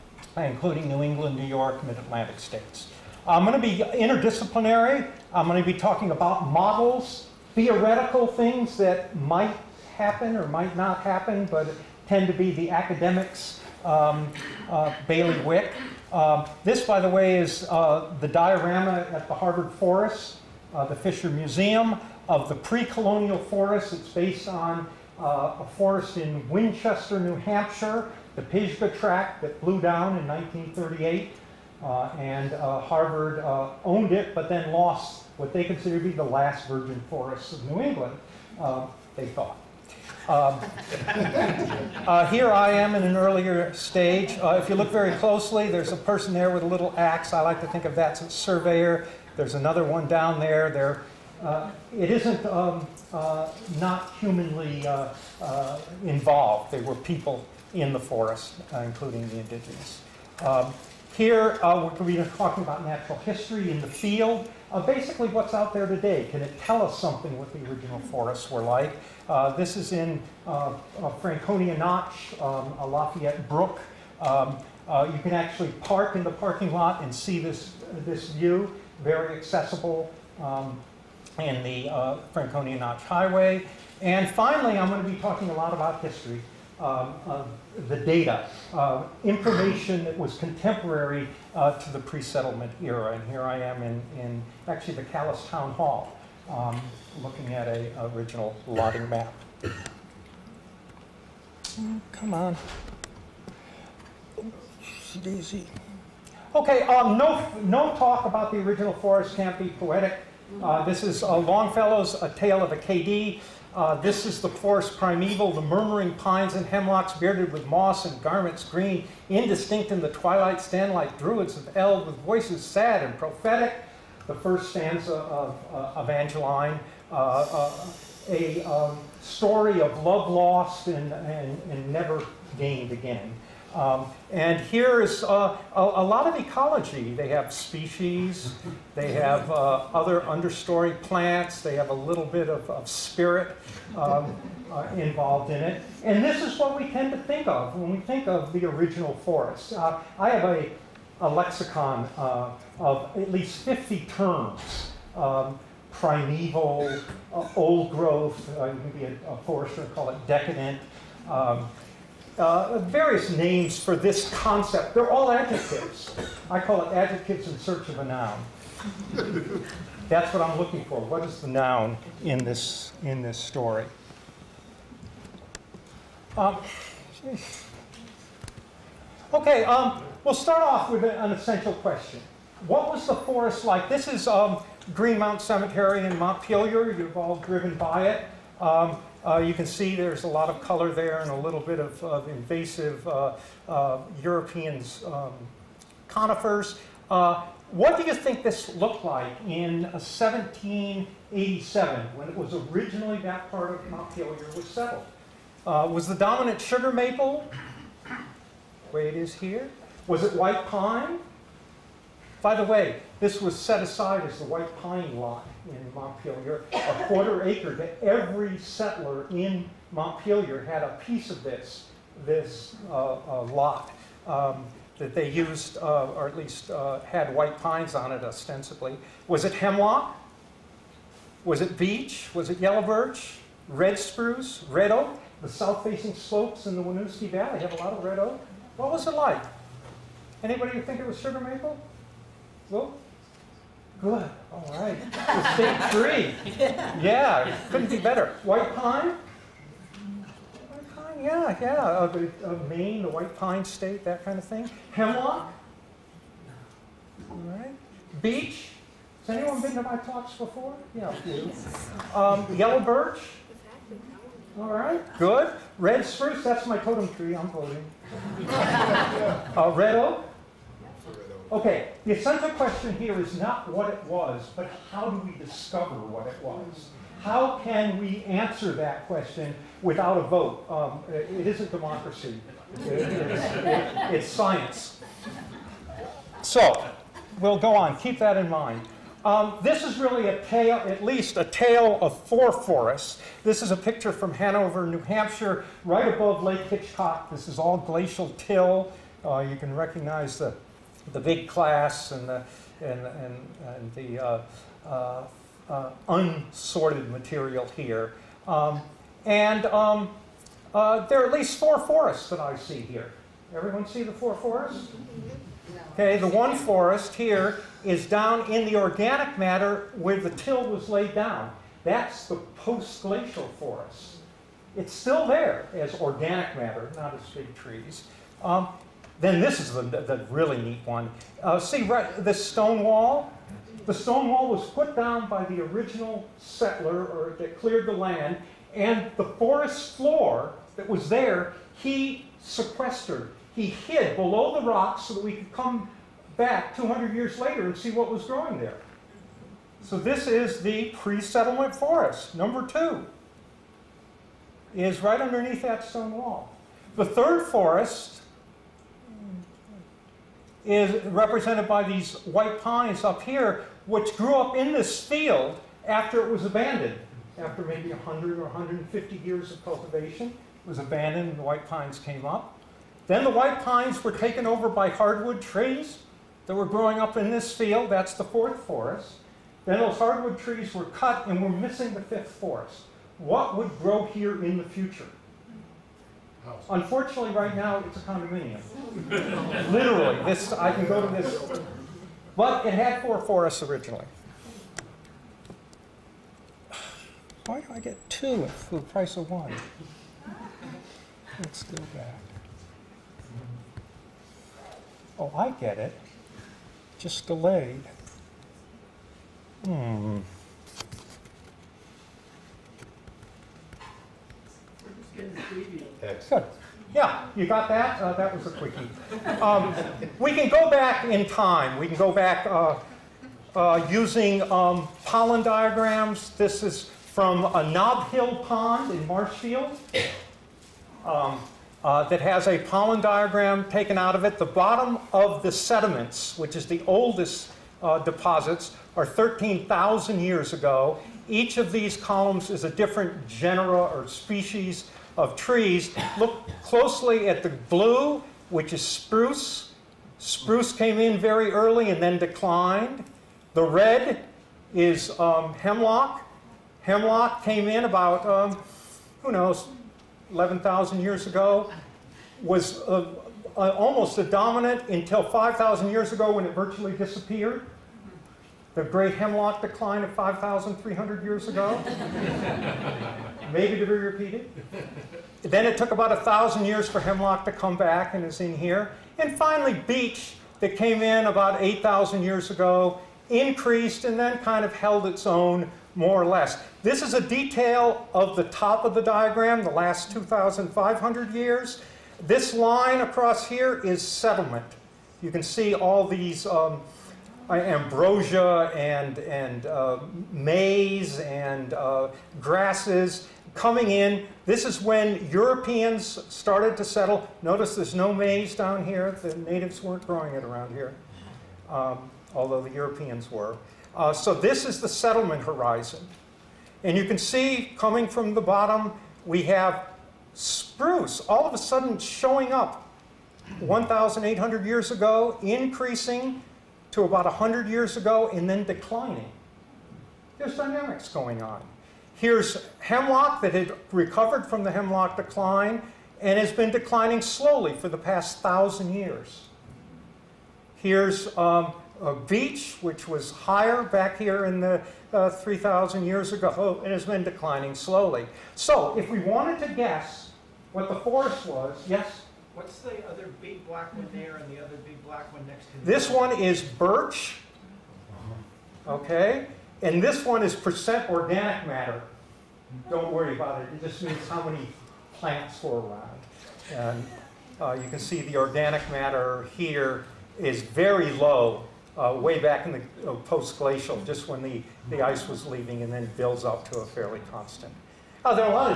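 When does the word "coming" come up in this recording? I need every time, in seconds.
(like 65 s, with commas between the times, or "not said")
503 s, 517 s.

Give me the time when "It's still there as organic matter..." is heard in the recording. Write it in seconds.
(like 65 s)
324 s.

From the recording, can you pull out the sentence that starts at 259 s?
Has anyone been to my talks before?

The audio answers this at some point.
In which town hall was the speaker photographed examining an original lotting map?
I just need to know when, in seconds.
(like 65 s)
95 s.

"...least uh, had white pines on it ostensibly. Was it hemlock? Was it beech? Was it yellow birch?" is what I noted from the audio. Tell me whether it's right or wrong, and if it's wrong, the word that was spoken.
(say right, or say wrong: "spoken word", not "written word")
right.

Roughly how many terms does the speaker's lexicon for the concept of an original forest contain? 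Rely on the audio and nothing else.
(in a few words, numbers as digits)
50.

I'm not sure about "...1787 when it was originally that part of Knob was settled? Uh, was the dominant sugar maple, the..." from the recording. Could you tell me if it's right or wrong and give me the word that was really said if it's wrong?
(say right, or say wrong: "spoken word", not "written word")
wrong: "Montpelier", not "Knob".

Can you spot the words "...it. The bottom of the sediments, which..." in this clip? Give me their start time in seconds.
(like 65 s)
434 s.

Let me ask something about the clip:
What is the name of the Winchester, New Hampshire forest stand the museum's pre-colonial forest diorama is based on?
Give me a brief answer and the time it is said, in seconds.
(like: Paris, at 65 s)
Pisgah Tract, at 28 s.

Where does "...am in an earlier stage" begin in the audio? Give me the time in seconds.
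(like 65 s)
42 s.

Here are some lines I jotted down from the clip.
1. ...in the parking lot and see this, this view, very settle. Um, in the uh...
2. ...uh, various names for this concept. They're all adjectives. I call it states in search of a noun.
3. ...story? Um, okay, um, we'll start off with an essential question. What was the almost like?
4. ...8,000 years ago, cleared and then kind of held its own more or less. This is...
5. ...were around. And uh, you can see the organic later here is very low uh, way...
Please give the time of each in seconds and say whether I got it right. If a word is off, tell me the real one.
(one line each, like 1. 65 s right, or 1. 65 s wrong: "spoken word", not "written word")
1. 76 s wrong: "accessible", not "settle"
2. 162 s wrong: "adjectives", not "states"
3. 173 s wrong: "forest", not "almost"
4. 481 s wrong: "increased", not "cleared"
5. 565 s wrong: "matter", not "later".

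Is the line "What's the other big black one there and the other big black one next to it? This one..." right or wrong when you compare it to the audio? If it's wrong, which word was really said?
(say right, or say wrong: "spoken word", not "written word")
right.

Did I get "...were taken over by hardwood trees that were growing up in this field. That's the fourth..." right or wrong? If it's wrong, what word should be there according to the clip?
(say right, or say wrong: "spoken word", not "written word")
right.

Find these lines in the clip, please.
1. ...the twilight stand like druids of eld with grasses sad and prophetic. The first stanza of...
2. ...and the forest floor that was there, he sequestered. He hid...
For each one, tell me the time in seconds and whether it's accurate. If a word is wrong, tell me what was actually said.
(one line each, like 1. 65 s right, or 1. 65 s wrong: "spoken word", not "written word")
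1. 120 s wrong: "voices", not "grasses"
2. 338 s right.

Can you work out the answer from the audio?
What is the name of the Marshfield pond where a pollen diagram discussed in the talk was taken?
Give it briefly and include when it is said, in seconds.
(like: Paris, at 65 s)
Knob Hill pond, at 427 s.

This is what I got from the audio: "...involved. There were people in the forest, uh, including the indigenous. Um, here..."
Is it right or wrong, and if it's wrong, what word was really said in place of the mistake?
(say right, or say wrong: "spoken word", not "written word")
right.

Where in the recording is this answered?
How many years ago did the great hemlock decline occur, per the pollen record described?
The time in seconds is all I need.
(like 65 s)
470 s.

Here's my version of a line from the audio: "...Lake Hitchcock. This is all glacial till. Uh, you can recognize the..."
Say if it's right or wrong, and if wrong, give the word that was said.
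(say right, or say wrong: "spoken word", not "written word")
right.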